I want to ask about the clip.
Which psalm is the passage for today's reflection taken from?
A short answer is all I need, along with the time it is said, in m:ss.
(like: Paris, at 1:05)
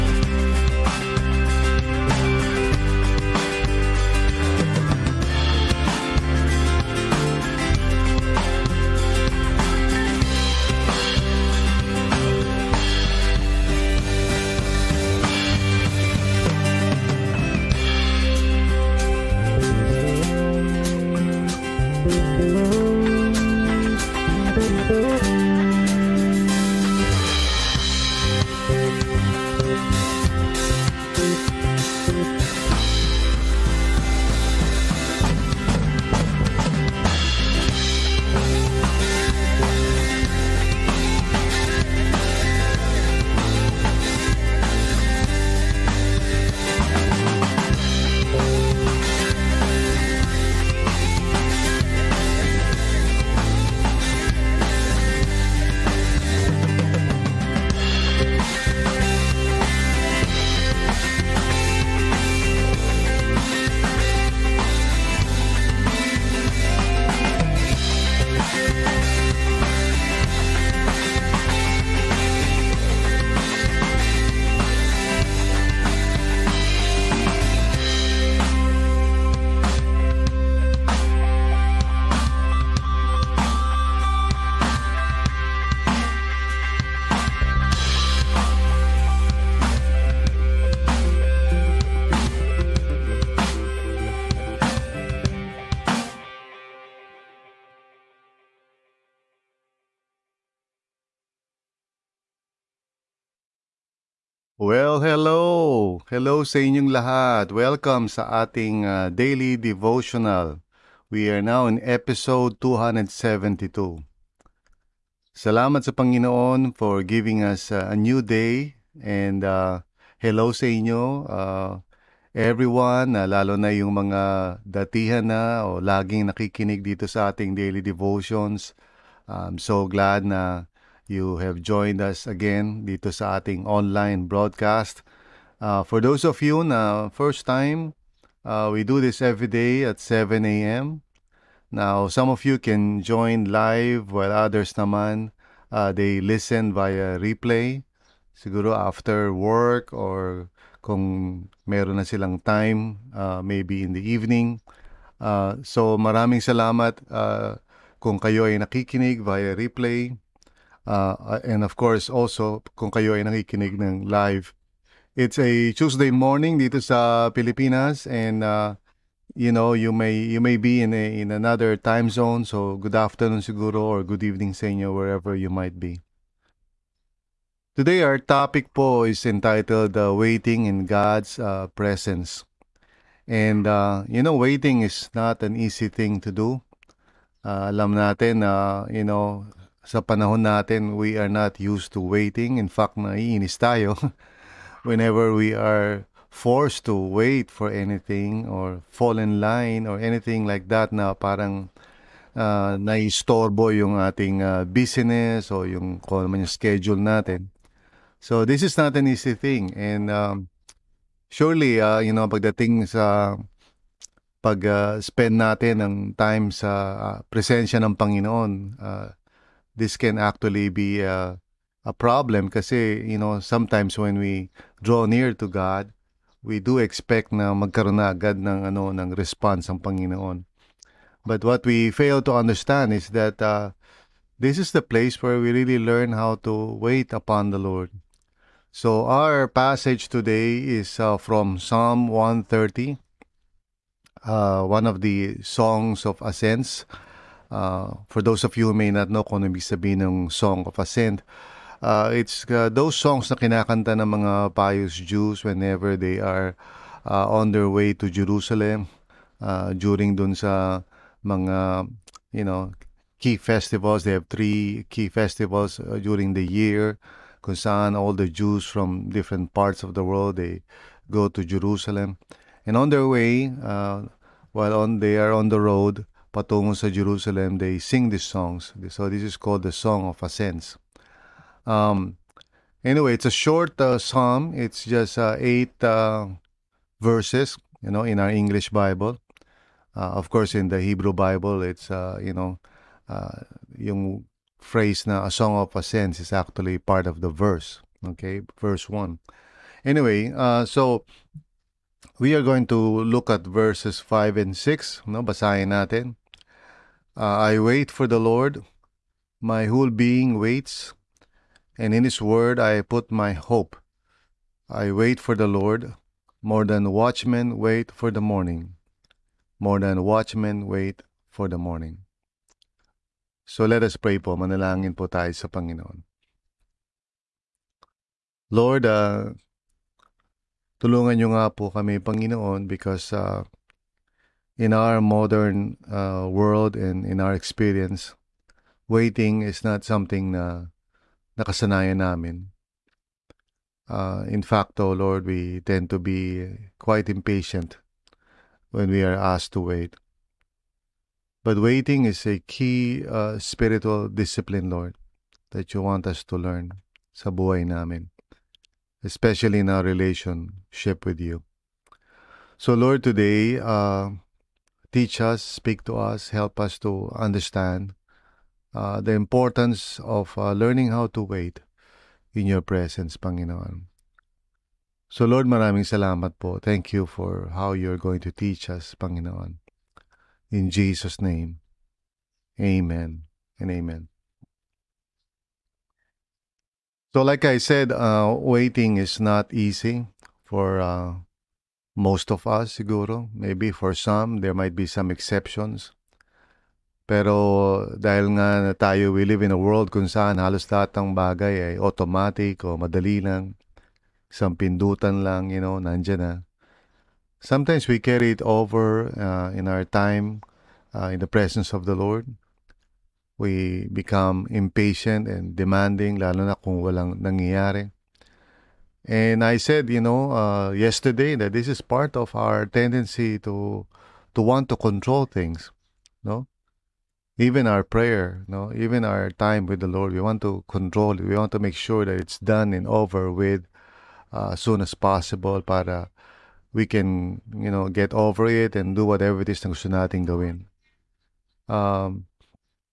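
Psalm 130, at 4:01.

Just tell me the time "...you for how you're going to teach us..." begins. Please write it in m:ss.
6:16.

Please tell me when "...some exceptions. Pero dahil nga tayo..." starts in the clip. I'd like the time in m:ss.
6:34.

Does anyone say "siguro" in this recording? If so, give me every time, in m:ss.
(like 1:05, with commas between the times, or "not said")
2:28, 2:53, 6:32.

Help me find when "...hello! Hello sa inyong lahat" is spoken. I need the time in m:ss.
1:45.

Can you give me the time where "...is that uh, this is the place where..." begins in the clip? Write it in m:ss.
3:52.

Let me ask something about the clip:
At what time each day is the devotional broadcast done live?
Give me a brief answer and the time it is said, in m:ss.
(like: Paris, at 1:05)
7 a.m., at 2:19.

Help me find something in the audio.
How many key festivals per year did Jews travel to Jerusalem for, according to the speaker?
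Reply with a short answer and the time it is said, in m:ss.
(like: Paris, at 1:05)
3, at 4:24.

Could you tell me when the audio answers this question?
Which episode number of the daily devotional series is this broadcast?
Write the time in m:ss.
1:52.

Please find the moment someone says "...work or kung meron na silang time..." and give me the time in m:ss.
2:29.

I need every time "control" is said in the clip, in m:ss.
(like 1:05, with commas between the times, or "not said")
7:04, 7:10.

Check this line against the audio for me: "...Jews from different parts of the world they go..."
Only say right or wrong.
right.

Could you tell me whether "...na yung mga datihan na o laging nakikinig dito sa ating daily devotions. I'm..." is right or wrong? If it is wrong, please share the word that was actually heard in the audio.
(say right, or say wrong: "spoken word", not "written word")
right.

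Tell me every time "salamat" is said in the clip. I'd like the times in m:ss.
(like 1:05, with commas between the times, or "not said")
1:55, 2:36, 6:15.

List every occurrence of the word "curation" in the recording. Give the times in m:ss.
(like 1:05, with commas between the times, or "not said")
not said.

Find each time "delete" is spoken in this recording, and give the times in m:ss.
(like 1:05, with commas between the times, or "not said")
not said.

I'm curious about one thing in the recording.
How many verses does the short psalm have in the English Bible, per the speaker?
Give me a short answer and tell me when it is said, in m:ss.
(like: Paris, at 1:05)
8, at 4:45.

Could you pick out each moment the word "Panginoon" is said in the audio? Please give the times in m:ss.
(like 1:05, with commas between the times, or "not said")
1:55, 3:37, 3:49, 5:25, 5:31, 6:13, 6:18.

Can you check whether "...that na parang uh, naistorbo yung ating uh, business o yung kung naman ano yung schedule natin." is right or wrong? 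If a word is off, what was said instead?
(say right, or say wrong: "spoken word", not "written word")
right.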